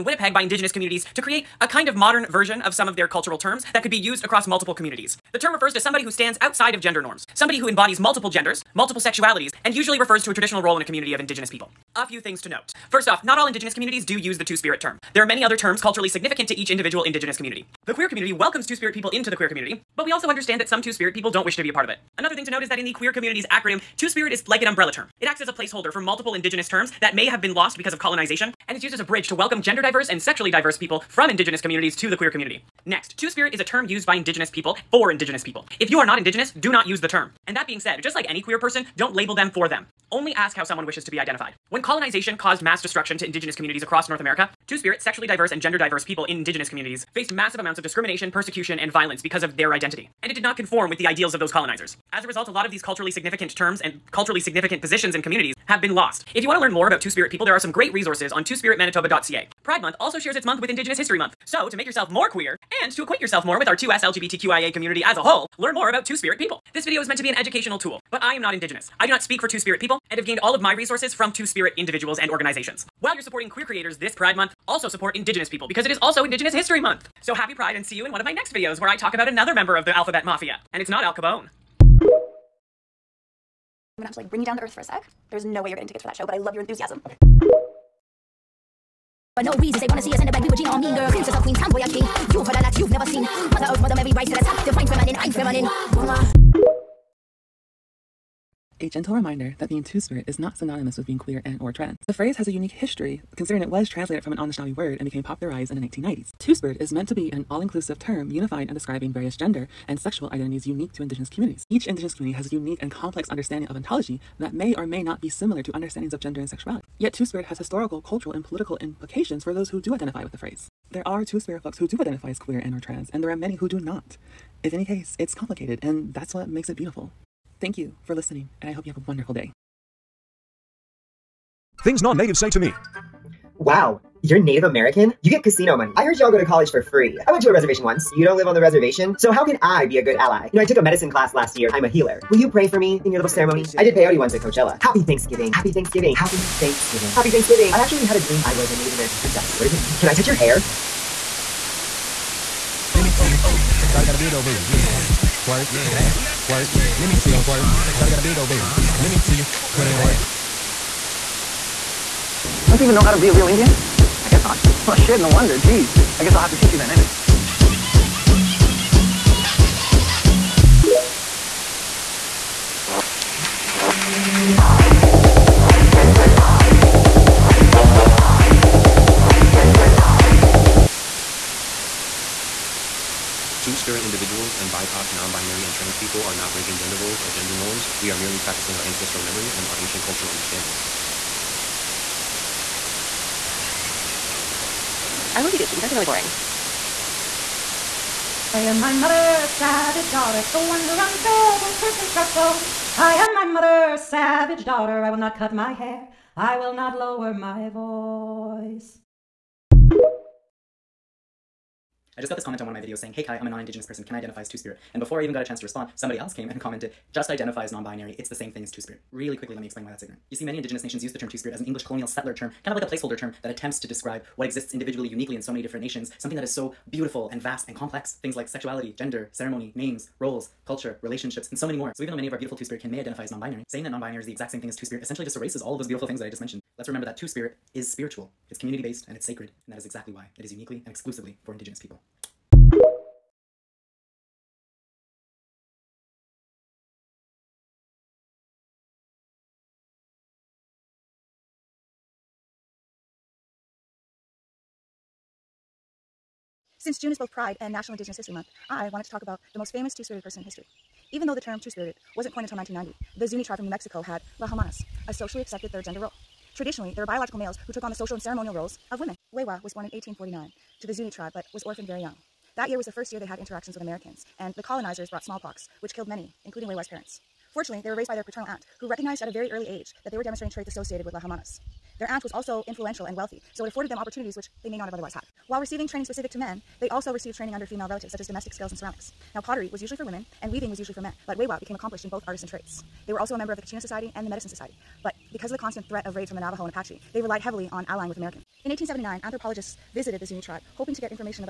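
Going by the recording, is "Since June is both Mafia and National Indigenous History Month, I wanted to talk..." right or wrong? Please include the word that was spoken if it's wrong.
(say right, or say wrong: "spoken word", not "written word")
wrong: "Pride", not "Mafia".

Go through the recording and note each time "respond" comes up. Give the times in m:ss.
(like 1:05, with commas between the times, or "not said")
3:35.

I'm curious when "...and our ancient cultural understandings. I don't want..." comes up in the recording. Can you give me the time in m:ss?
3:09.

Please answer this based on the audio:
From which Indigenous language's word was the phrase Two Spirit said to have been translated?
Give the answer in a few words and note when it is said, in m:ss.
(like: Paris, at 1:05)
Anishinaabe, at 1:44.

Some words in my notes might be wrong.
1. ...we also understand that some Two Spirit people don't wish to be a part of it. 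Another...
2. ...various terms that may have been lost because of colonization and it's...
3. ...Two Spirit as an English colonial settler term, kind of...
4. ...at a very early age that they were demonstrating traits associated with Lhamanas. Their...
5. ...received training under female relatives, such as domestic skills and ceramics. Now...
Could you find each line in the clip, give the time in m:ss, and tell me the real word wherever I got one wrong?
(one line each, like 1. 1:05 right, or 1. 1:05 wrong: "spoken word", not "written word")
1. 0:20 right
2. 0:26 wrong: "indigenous", not "various"
3. 3:41 right
4. 4:39 right
5. 4:47 right.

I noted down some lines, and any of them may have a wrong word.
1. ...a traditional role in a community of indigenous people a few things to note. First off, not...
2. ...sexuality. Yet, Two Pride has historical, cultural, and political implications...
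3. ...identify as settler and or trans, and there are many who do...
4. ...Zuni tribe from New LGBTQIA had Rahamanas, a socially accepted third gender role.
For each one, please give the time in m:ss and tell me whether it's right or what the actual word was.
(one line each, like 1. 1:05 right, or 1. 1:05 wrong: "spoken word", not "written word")
1. 0:10 right
2. 1:56 wrong: "Spirit", not "Pride"
3. 2:02 wrong: "queer", not "settler"
4. 4:23 wrong: "Mexico", not "LGBTQIA".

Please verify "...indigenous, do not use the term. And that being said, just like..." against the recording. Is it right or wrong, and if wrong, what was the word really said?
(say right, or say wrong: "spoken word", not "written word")
right.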